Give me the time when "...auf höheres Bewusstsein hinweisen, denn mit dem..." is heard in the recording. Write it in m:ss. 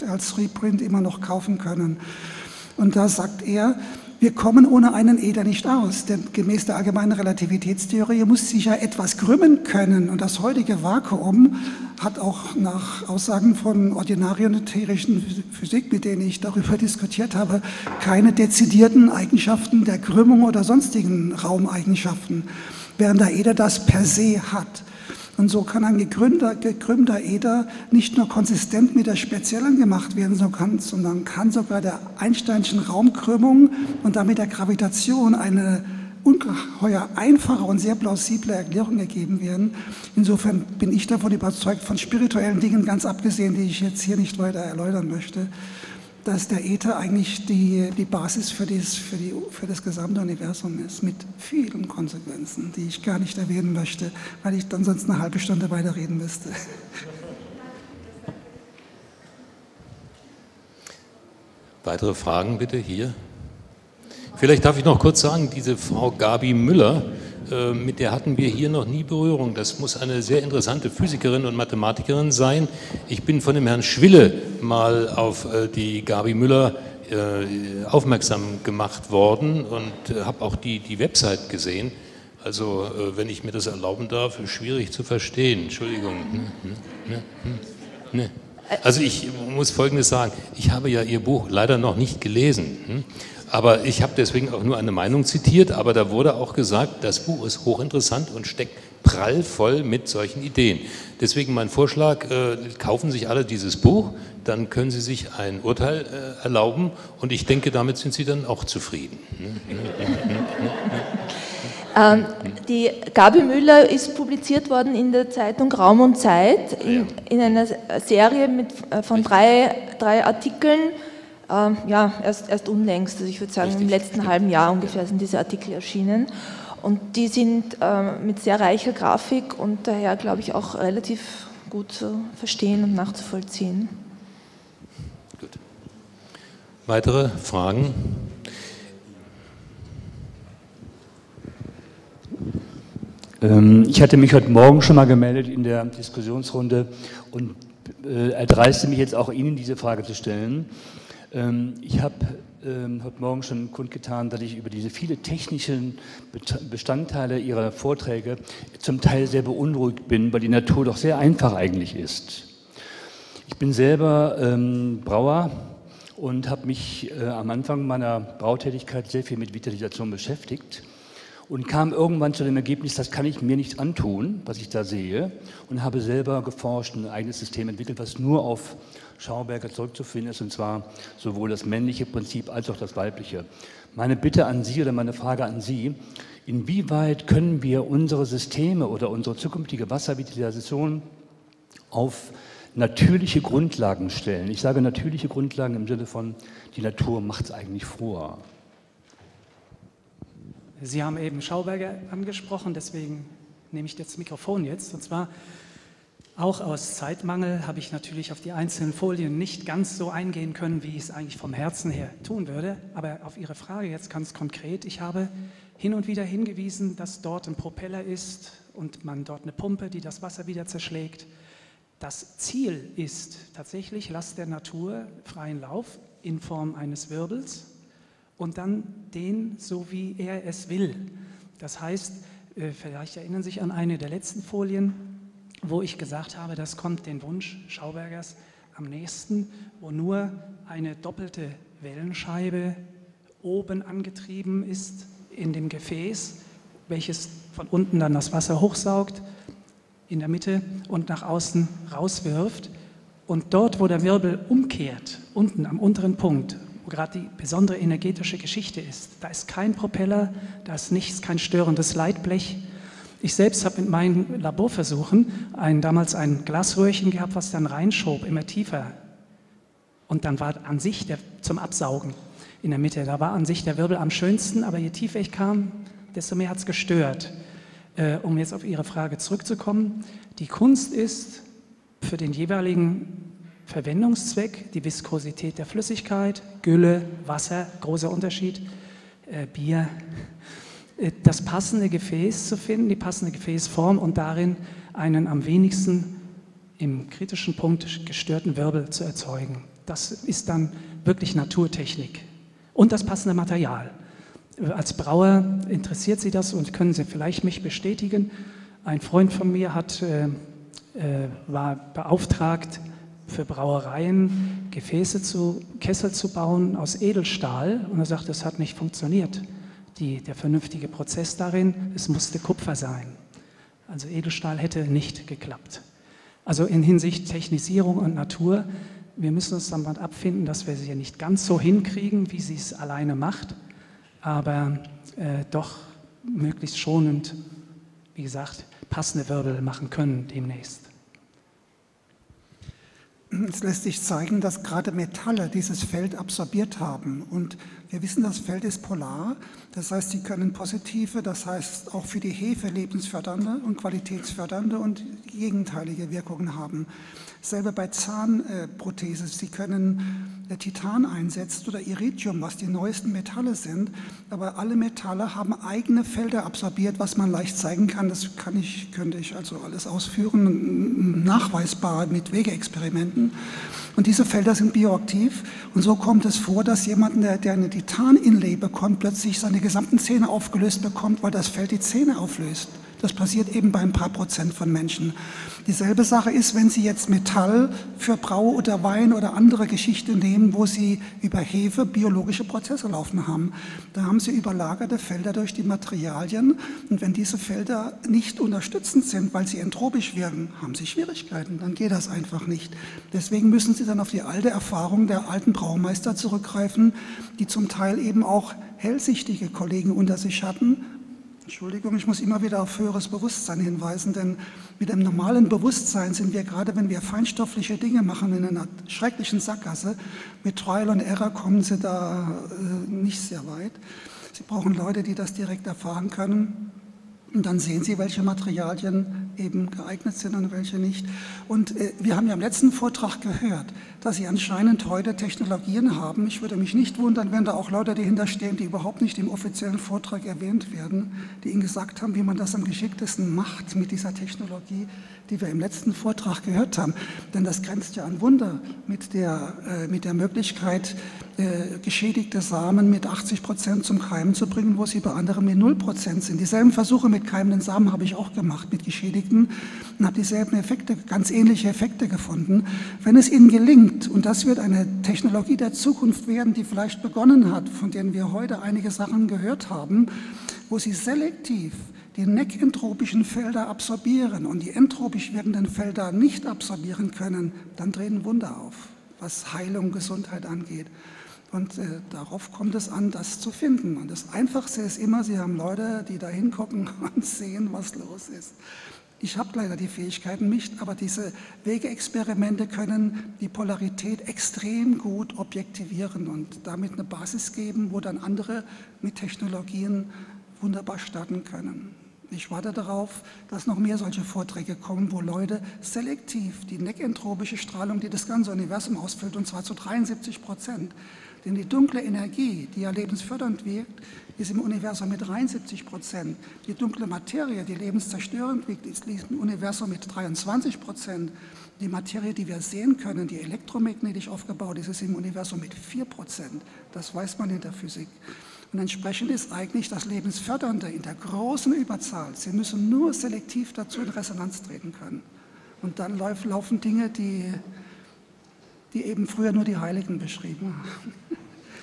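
6:52.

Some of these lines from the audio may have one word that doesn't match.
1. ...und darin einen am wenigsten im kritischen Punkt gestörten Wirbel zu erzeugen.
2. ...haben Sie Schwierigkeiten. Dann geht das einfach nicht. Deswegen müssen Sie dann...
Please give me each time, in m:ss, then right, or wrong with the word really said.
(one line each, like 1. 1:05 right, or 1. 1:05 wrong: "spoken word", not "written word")
1. 4:53 right
2. 6:40 right.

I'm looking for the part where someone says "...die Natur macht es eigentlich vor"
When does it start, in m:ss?
3:16.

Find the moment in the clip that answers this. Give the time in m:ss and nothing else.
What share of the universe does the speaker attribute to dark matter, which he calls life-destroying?
8:40.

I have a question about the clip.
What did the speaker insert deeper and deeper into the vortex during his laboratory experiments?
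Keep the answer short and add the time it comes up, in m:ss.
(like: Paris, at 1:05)
Glasröhrchen, at 4:26.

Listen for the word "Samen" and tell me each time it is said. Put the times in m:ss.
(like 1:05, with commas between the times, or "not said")
7:32, 7:37.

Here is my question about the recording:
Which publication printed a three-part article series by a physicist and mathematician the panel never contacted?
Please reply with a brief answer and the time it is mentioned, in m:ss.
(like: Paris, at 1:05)
Raum und Zeit, at 1:55.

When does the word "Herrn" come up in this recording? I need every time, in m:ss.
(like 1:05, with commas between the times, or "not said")
1:13.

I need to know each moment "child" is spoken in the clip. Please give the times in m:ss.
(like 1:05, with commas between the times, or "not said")
not said.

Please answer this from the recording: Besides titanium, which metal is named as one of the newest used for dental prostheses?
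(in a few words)
Iridium.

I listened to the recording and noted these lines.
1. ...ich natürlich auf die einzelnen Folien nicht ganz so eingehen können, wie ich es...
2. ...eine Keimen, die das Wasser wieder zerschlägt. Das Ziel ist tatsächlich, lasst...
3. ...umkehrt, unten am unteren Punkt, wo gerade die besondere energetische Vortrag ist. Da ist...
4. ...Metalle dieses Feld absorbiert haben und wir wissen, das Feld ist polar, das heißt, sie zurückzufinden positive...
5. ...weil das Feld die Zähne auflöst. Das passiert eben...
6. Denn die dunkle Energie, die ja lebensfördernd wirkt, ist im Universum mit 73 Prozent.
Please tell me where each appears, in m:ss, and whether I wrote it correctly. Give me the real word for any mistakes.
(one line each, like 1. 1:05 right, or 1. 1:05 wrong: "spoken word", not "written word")
1. 3:27 right
2. 3:39 wrong: "Pumpe", not "Keimen"
3. 4:14 wrong: "Geschichte", not "Vortrag"
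4. 5:44 wrong: "können", not "zurückzufinden"
5. 6:21 right
6. 8:31 right.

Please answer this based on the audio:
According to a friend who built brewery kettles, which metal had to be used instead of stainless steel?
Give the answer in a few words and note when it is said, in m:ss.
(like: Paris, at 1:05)
Kupfer, at 5:22.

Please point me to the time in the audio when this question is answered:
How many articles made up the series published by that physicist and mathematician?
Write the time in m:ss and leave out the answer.
1:59.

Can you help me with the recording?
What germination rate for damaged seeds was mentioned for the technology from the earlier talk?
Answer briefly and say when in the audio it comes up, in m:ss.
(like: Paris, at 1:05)
80 Prozent, at 7:33.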